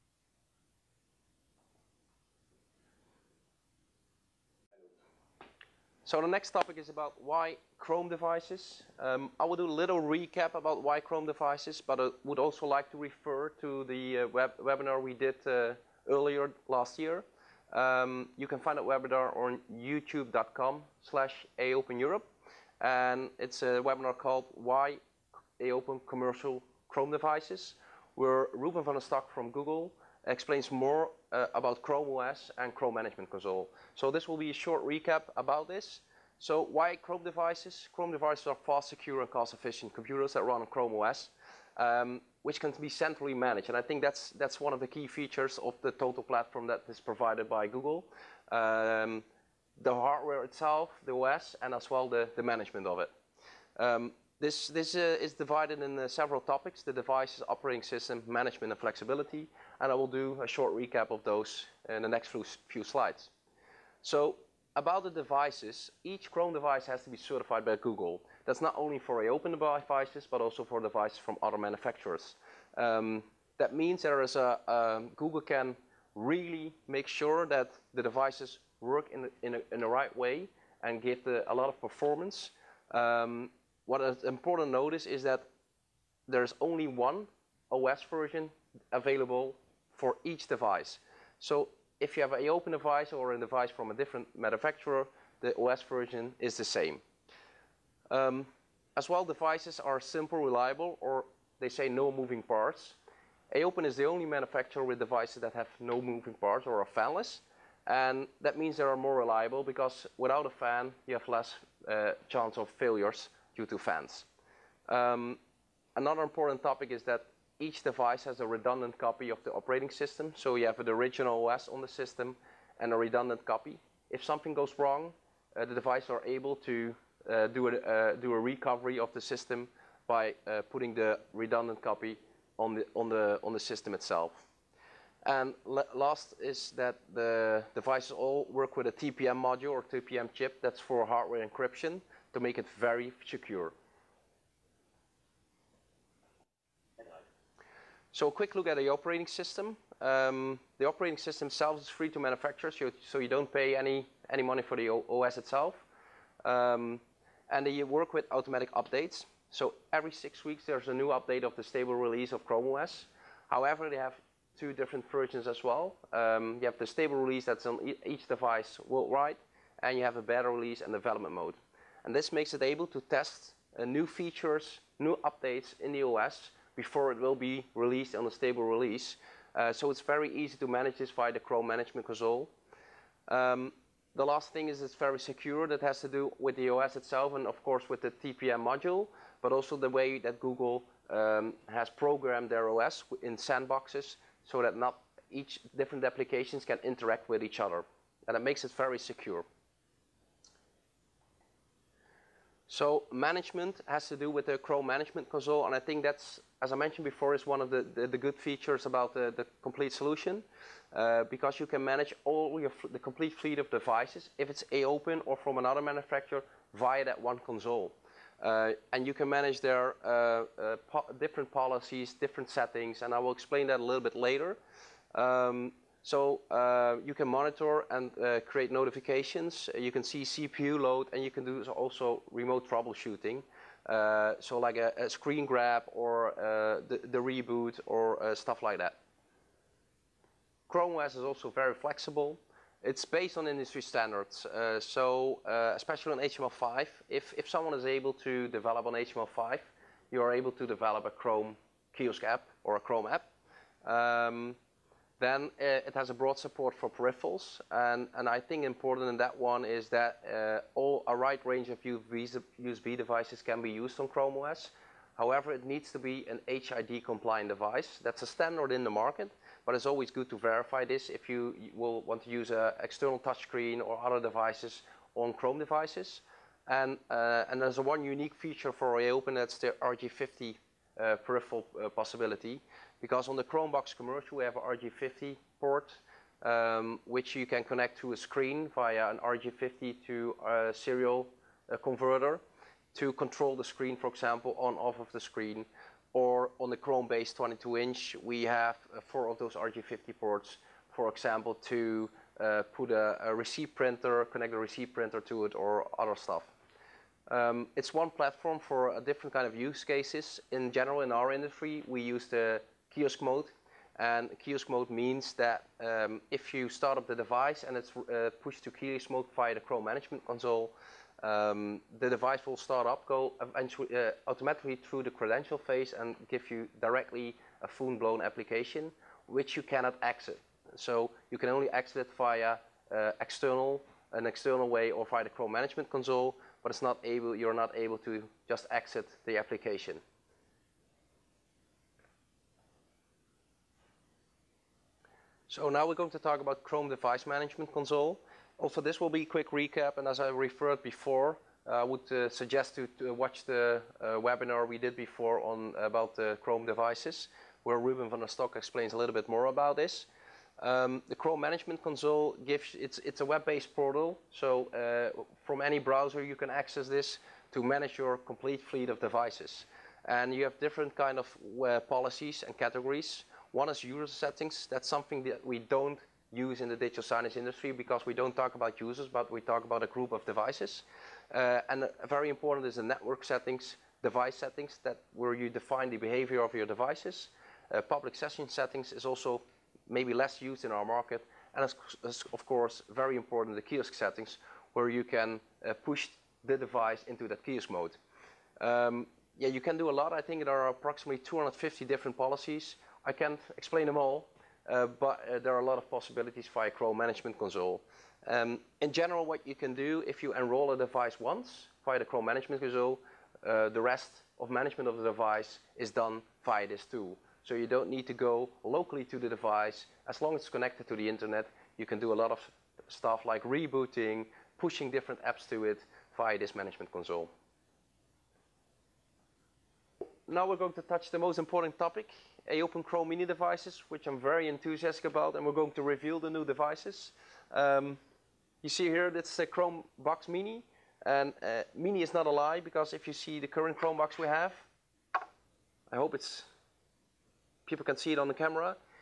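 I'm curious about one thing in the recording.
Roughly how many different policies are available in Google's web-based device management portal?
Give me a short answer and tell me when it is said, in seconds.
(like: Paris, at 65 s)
250, at 401 s.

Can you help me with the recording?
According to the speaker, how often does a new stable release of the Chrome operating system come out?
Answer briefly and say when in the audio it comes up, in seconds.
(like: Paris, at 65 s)
every 6 weeks, at 159 s.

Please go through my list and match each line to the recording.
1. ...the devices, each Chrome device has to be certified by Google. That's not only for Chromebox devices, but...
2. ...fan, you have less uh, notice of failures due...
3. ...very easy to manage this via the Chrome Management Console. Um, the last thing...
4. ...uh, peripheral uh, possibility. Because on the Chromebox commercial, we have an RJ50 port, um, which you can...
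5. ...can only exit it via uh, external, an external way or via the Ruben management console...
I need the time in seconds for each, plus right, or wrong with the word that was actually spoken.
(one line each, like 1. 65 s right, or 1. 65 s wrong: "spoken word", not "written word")
1. 65 s wrong: "AOpen", not "Chromebox"
2. 110 s wrong: "chance", not "notice"
3. 180 s right
4. 280 s right
5. 331 s wrong: "Chrome", not "Ruben".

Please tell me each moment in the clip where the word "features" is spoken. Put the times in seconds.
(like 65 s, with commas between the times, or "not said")
45 s, 174 s, 208 s, 278 s.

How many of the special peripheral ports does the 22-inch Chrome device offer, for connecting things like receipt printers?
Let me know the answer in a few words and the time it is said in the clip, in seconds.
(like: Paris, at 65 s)
4, at 299 s.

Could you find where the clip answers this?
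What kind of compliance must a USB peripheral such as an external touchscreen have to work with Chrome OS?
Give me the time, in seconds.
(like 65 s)
266 s.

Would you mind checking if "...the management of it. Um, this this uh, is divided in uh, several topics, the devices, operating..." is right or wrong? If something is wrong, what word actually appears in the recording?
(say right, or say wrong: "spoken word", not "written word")
right.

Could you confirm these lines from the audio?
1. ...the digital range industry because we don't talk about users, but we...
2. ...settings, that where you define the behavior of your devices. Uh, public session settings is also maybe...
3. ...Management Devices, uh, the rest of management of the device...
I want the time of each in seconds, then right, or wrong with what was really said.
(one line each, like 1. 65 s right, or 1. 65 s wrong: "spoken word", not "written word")
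1. 376 s wrong: "signage", not "range"
2. 384 s right
3. 412 s wrong: "Console", not "Devices".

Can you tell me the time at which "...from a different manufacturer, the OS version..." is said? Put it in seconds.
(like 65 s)
93 s.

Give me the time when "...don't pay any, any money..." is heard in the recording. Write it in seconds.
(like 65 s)
153 s.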